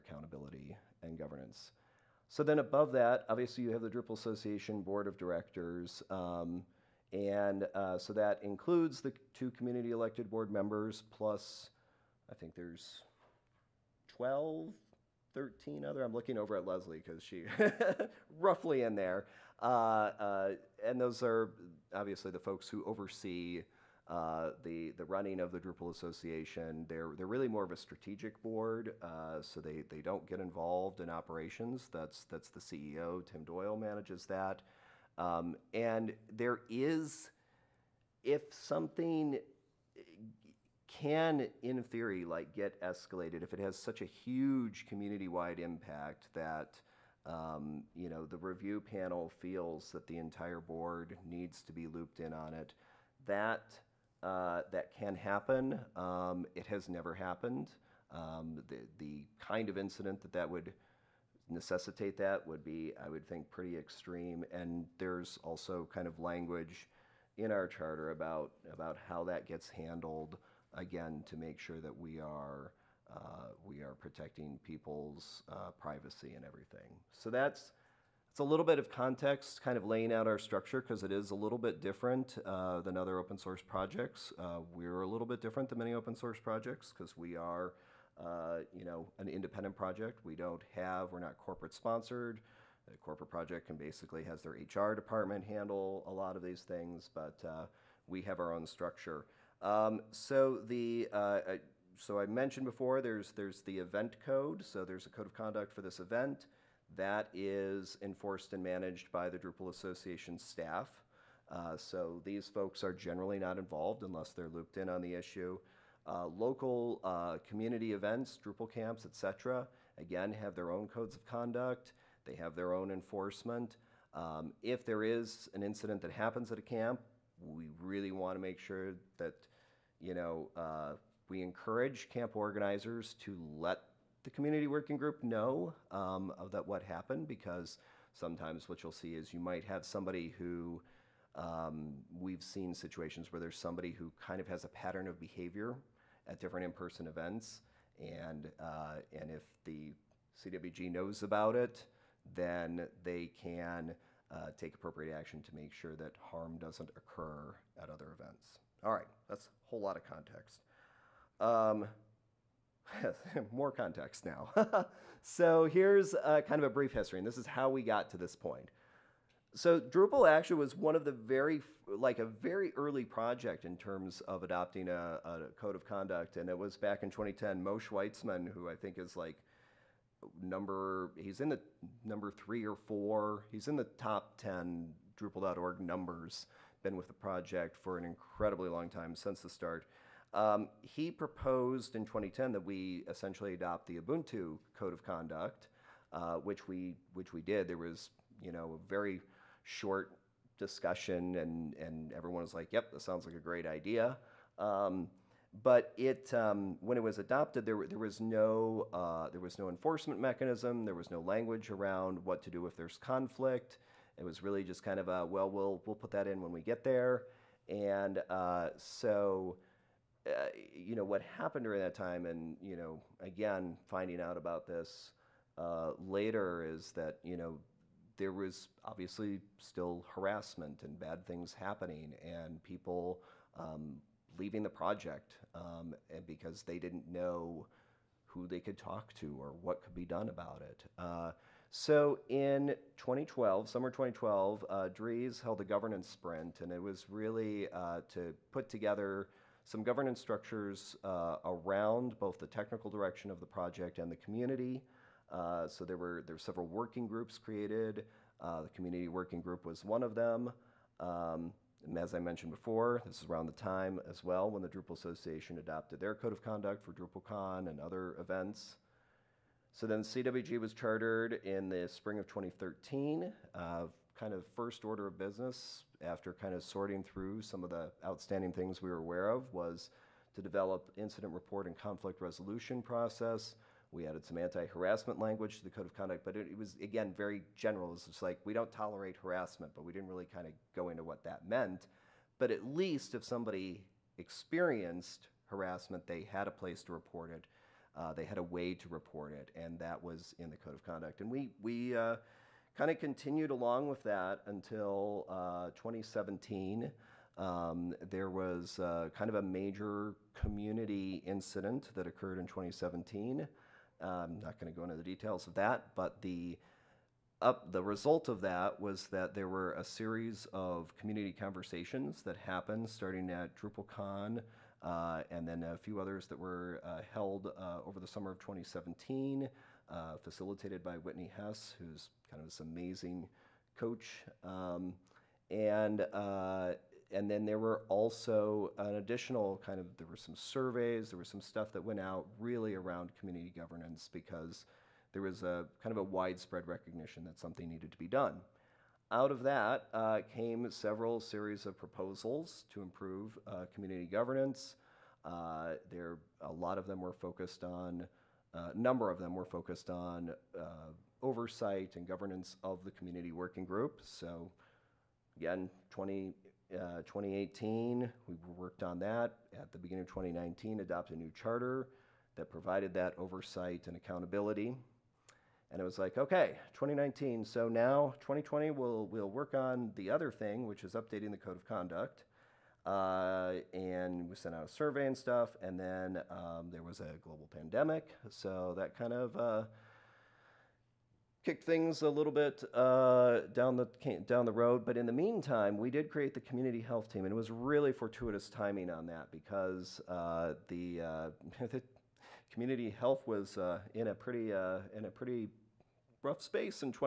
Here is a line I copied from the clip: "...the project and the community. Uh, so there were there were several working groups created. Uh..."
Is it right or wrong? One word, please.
right.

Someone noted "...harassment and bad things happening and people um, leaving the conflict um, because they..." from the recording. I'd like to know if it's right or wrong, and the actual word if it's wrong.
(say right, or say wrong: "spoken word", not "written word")
wrong: "project", not "conflict".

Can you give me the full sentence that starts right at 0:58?
Um, the the kind of incident that that would necessitate that would be, I would think, pretty extreme.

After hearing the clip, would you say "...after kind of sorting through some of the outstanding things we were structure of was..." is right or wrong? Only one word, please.
wrong.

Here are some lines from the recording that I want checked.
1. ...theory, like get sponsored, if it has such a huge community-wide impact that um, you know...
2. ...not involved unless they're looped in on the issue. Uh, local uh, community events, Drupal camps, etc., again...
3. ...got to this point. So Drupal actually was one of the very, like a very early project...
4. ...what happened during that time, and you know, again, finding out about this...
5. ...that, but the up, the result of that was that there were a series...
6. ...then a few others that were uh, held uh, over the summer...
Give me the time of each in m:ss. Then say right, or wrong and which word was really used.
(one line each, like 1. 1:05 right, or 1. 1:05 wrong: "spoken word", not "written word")
1. 0:41 wrong: "escalated", not "sponsored"
2. 1:53 right
3. 2:47 right
4. 3:41 right
5. 5:15 right
6. 5:25 right.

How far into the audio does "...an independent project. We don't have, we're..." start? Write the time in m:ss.
1:29.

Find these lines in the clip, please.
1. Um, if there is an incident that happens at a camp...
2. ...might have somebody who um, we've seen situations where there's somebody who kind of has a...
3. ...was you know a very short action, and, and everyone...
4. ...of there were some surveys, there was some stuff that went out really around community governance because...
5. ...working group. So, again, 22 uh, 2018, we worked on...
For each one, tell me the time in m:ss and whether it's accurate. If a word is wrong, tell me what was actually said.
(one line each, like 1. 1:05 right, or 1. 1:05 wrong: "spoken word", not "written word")
1. 2:04 right
2. 2:19 right
3. 3:17 wrong: "discussion", not "action"
4. 5:39 right
5. 6:03 wrong: "20", not "22".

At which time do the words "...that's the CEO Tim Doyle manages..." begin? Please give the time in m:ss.
0:32.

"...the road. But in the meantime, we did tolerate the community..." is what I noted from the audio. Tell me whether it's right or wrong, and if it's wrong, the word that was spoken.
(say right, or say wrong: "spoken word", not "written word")
wrong: "create", not "tolerate".